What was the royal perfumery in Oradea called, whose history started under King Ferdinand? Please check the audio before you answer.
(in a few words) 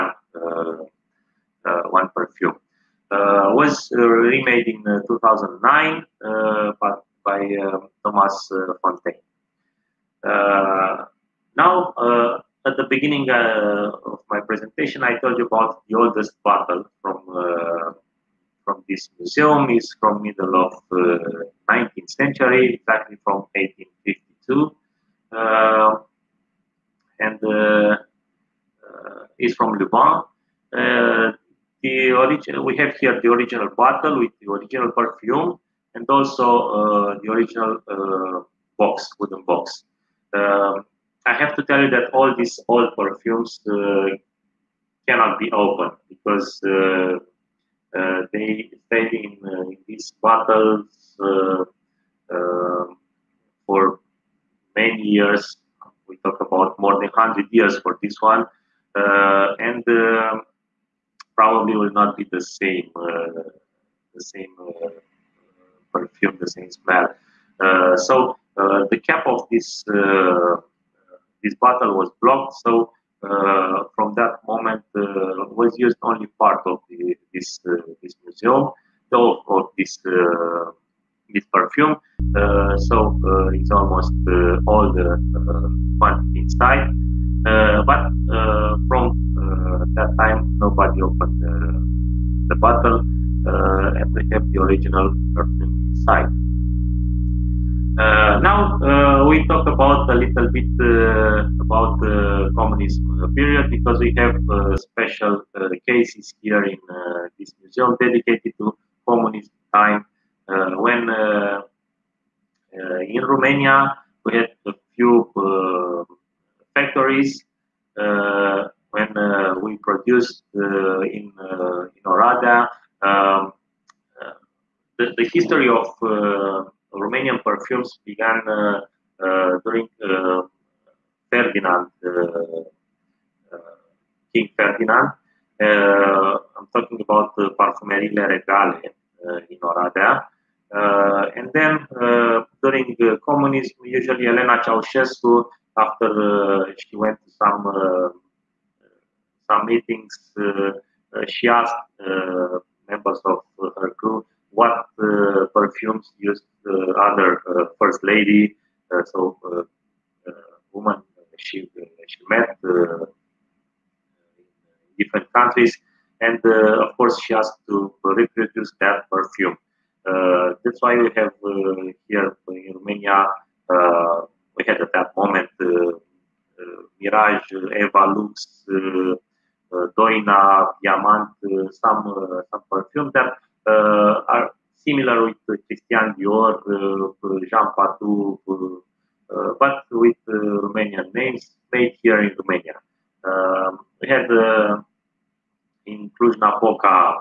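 Parfumerile Regale.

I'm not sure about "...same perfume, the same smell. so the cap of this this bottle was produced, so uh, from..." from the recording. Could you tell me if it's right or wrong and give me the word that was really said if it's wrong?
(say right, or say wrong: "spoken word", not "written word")
wrong: "blocked", not "produced".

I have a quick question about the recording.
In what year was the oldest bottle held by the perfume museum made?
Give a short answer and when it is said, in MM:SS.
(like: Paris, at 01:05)
1852, at 00:23.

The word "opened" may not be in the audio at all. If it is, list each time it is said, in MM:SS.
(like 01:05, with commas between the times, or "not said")
00:45, 01:31.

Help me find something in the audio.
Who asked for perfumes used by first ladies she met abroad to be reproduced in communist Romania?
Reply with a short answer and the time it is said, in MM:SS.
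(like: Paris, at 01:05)
Elena Ceausescu, at 02:24.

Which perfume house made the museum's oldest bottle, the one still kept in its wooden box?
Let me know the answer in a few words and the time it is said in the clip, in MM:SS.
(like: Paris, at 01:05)
Lubin, at 00:29.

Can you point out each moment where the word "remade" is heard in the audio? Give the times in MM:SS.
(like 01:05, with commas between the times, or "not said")
00:03.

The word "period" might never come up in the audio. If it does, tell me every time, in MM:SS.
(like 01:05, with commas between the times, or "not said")
01:43.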